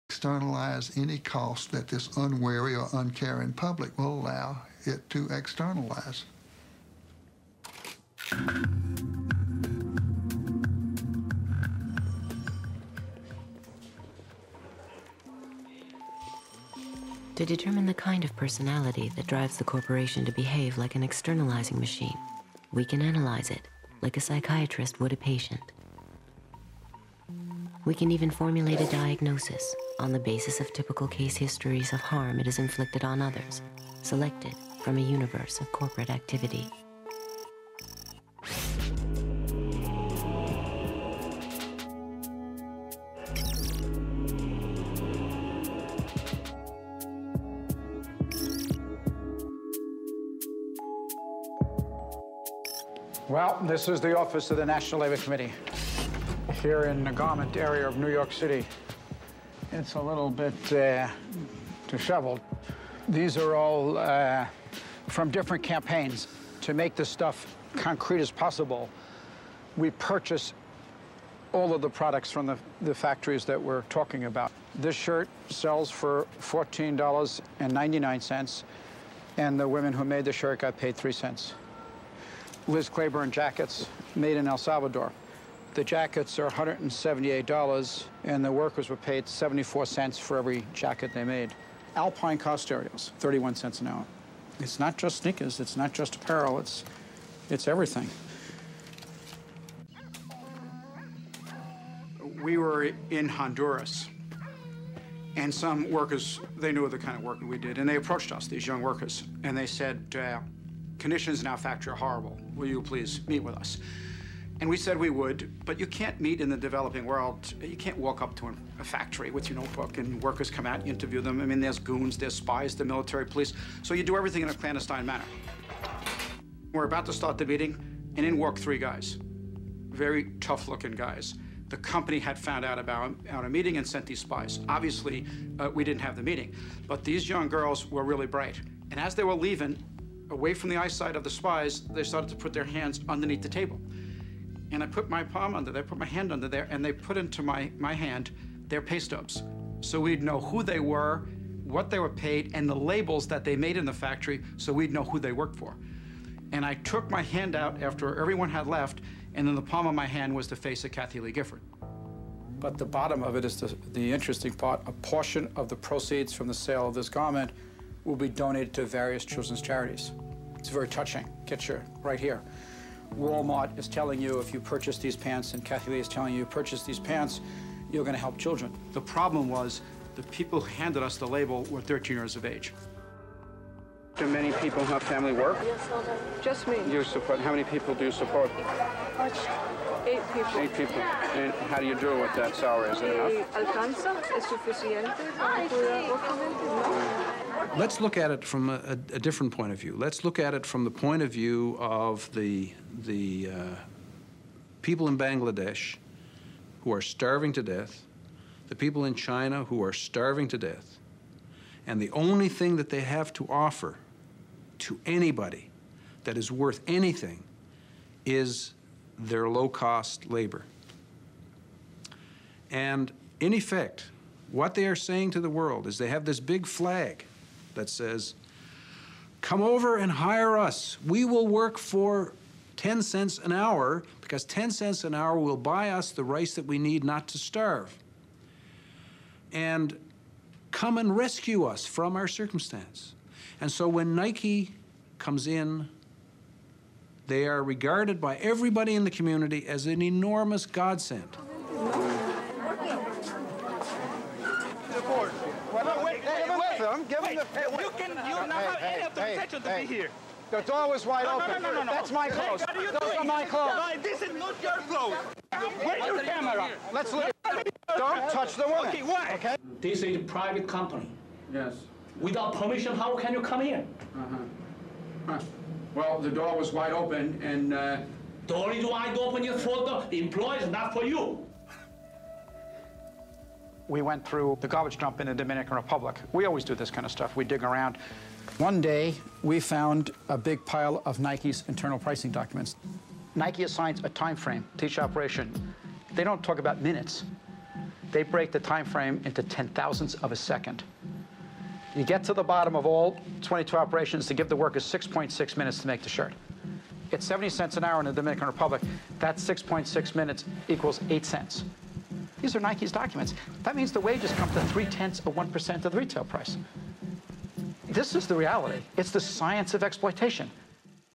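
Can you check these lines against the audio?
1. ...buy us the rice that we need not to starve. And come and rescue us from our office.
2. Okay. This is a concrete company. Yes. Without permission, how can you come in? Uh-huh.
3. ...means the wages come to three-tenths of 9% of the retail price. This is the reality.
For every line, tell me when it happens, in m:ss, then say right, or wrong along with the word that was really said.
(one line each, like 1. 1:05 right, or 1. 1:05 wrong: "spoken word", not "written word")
1. 3:55 wrong: "circumstance", not "office"
2. 4:29 wrong: "private", not "concrete"
3. 5:13 wrong: "1", not "9".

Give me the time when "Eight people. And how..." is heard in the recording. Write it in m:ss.
3:10.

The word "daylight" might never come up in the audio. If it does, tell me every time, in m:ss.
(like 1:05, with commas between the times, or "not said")
not said.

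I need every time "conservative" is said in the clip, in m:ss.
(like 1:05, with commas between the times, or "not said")
not said.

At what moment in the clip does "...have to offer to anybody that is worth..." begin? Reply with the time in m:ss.
3:33.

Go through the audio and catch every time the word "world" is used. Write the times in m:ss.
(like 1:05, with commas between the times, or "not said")
1:57, 3:45.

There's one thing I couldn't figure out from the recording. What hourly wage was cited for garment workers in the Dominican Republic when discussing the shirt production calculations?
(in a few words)
70 cents.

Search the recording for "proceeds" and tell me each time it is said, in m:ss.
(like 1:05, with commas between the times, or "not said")
2:45.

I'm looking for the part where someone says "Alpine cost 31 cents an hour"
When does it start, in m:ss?
1:31.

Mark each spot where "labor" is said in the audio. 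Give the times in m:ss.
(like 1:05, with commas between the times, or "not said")
0:55, 3:40.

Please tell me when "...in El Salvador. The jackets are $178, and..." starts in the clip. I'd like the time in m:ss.
1:24.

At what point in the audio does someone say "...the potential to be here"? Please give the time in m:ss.
4:19.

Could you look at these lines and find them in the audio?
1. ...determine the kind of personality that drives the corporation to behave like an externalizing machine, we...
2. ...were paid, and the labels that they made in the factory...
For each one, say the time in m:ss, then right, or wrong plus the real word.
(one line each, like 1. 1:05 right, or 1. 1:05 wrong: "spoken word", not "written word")
1. 0:17 right
2. 2:31 right.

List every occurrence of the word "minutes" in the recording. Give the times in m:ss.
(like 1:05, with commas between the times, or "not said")
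4:56, 5:05, 5:10.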